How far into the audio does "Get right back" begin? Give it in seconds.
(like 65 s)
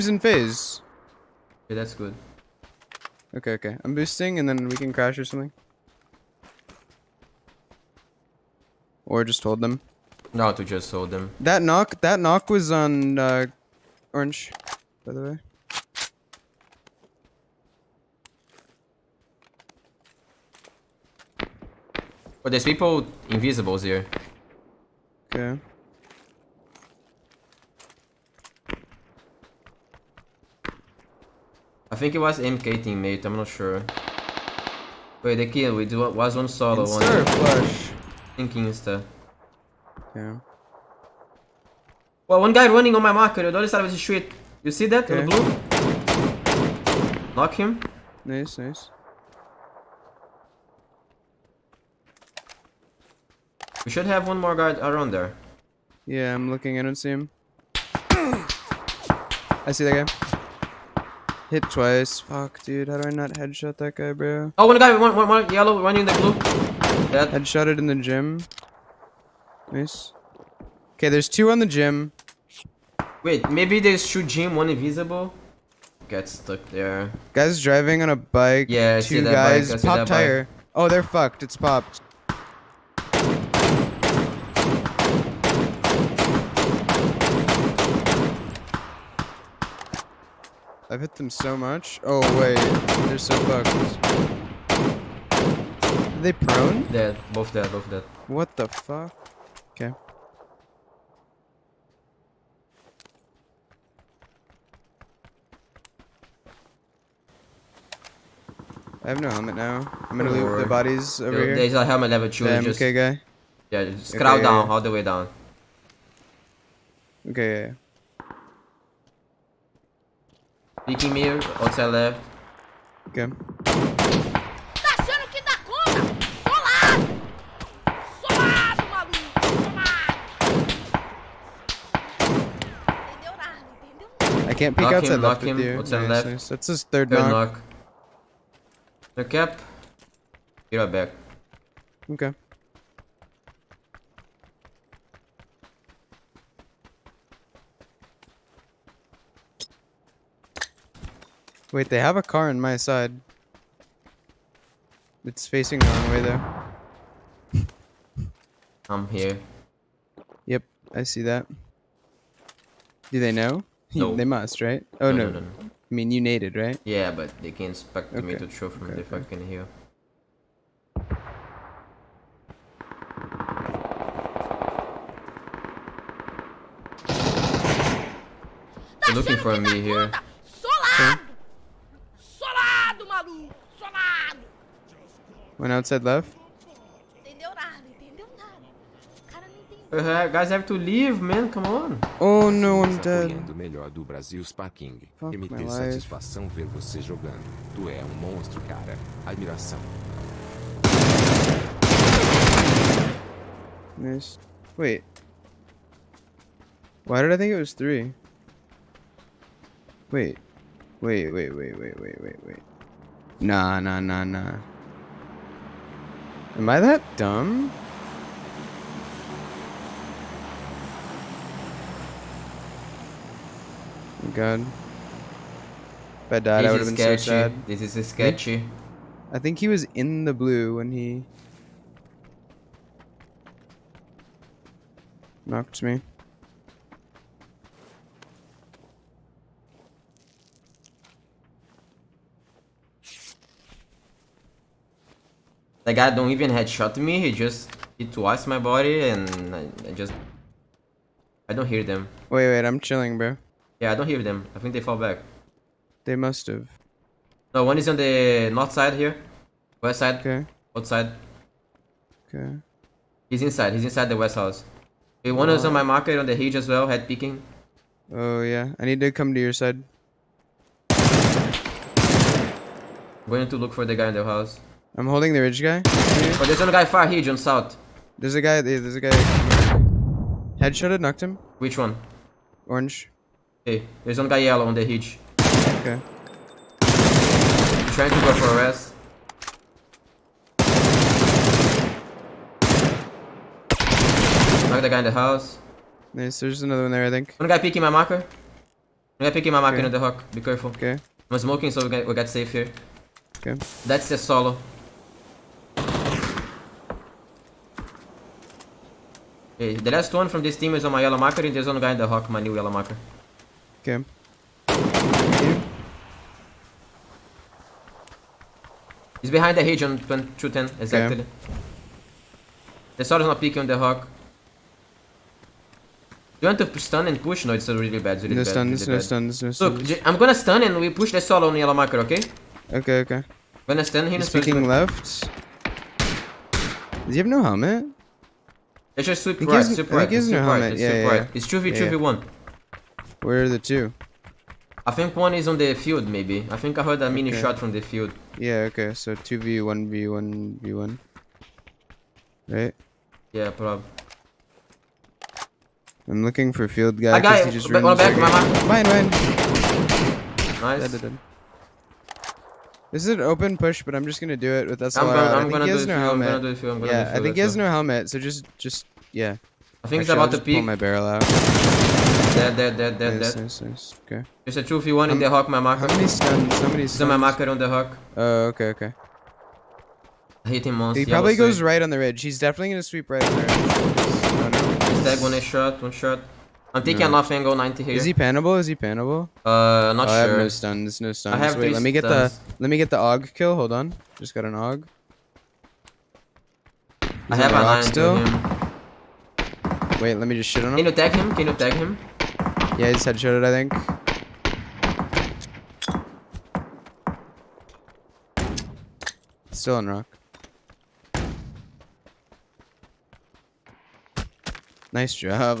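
140 s.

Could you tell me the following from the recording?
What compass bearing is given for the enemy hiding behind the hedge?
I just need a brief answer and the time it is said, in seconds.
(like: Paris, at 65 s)
210, at 319 s.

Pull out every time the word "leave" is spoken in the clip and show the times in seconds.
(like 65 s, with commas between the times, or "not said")
110 s, 190 s.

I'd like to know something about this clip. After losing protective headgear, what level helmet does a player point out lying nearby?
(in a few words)
Level two.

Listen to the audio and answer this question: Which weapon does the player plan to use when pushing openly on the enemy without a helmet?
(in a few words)
SLR.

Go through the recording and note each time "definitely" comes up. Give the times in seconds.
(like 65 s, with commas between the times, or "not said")
382 s.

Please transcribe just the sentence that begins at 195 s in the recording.
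Fuck MT satisfação ver você jogando.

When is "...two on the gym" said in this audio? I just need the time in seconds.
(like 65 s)
71 s.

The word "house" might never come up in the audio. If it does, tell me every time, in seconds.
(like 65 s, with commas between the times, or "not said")
264 s, 274 s, 295 s.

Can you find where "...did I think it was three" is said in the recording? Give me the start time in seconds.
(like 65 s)
207 s.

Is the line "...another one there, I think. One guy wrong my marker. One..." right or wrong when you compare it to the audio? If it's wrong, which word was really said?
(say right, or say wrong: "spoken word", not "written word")
wrong: "peeking", not "wrong".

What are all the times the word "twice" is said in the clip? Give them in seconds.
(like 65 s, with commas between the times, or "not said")
61 s, 248 s.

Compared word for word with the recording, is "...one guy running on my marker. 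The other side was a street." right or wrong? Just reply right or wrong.
right.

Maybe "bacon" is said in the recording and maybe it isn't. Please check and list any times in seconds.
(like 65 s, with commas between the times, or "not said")
not said.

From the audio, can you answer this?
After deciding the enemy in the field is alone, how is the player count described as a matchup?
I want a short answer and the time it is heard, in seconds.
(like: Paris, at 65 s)
1v1v1, at 349 s.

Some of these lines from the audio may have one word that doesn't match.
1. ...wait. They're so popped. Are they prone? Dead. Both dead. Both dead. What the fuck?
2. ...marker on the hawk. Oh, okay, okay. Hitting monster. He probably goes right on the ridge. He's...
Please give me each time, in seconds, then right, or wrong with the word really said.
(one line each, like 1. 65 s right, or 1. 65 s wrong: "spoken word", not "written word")
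1. 92 s wrong: "fucked", not "popped"
2. 377 s right.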